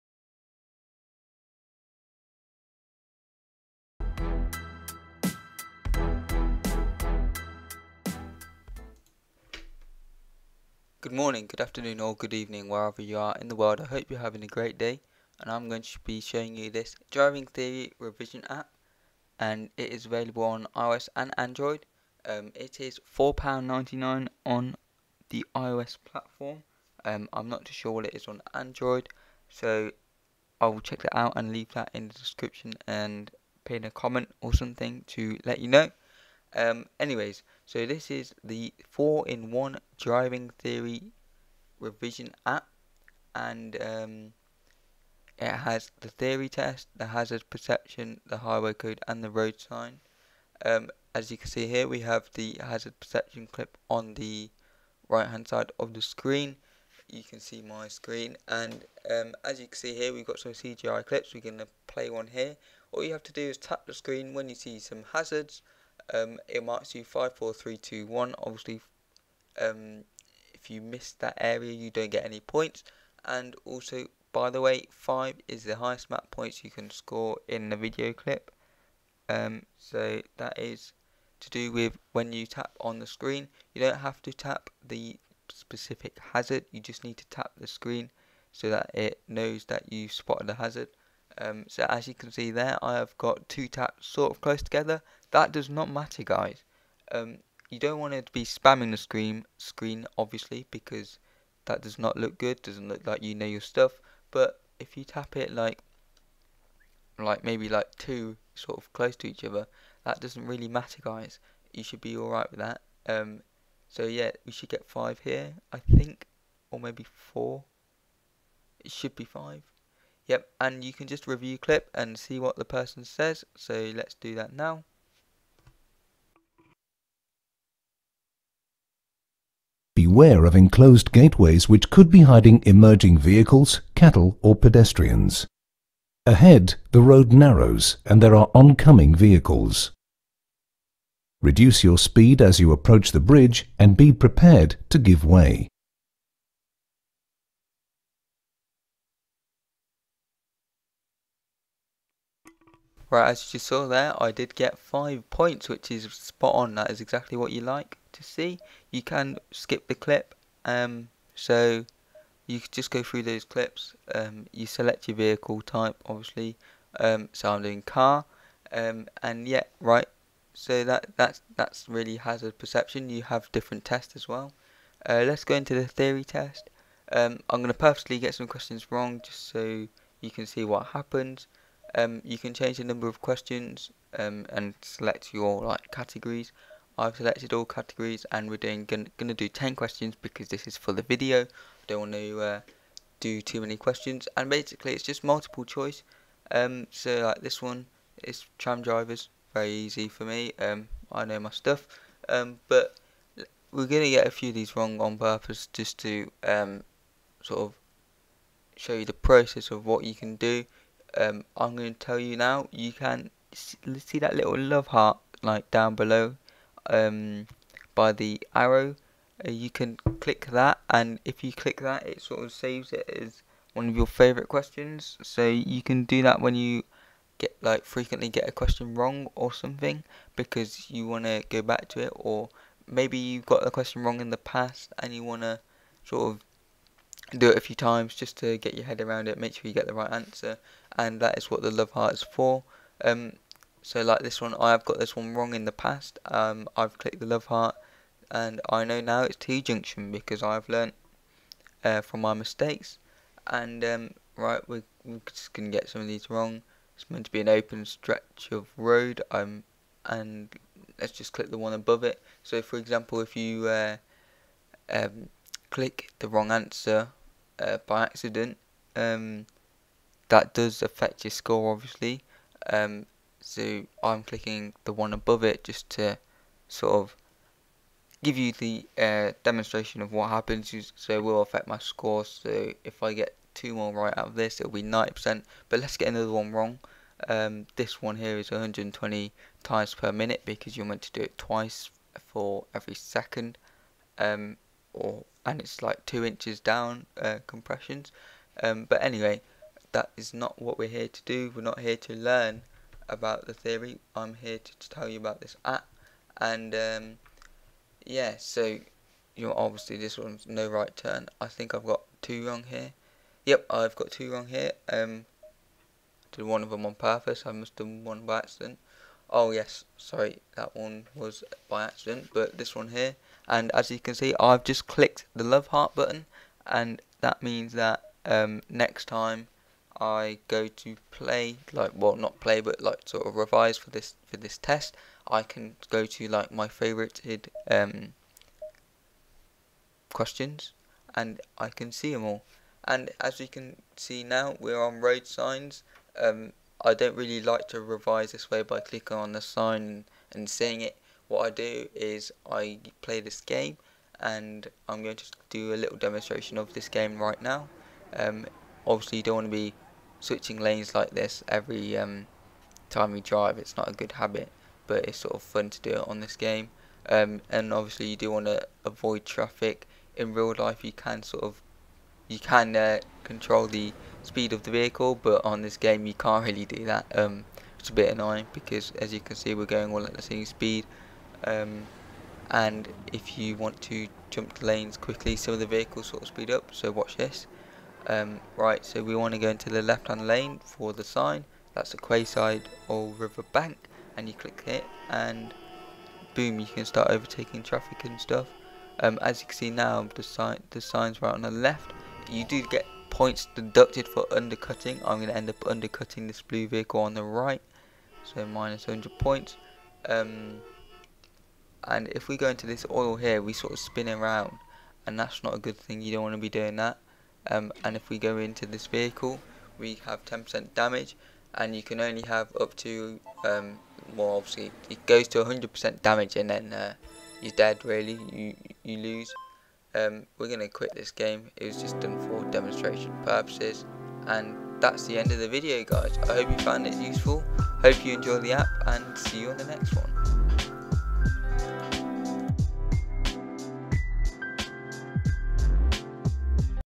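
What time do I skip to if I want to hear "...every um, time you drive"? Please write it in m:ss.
6:01.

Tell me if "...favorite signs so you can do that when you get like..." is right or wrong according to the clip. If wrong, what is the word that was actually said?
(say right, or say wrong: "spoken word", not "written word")
wrong: "questions", not "signs".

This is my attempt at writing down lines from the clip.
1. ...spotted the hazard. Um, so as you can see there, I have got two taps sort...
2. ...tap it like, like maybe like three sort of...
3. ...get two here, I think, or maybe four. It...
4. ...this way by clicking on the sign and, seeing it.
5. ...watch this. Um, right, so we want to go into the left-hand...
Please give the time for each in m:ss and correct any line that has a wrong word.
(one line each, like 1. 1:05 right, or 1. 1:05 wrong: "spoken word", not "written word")
1. 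1:30 right
2. 1:45 wrong: "two", not "three"
3. 1:54 wrong: "five", not "two"
4. 5:48 right
5. 6:26 right.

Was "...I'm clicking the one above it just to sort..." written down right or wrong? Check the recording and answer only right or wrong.
right.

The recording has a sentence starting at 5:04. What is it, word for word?
I'm here to, to tell you about this app, and um, yeah, so you know, obviously this one's no right turn.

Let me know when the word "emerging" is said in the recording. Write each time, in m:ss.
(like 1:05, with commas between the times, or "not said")
2:12.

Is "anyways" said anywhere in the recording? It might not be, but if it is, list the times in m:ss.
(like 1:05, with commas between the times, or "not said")
0:36, 4:59.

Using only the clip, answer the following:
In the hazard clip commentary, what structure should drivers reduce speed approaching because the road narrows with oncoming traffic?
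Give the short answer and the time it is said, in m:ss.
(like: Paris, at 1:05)
the bridge, at 2:23.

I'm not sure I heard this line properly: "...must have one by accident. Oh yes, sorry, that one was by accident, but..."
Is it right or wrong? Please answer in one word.
right.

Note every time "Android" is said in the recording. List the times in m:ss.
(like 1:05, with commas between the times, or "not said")
0:21, 0:28.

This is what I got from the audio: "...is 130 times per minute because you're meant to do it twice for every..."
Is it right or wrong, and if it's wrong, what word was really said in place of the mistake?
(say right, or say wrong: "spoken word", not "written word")
wrong: "120", not "130".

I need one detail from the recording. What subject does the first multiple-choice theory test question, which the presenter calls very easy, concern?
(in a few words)
tram drivers.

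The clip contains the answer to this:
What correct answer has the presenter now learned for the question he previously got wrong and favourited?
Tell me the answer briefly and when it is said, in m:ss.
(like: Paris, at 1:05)
T-junction, at 4:09.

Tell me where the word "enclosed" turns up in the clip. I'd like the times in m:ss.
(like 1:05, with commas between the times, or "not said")
2:10.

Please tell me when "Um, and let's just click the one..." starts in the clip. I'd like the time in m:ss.
4:19.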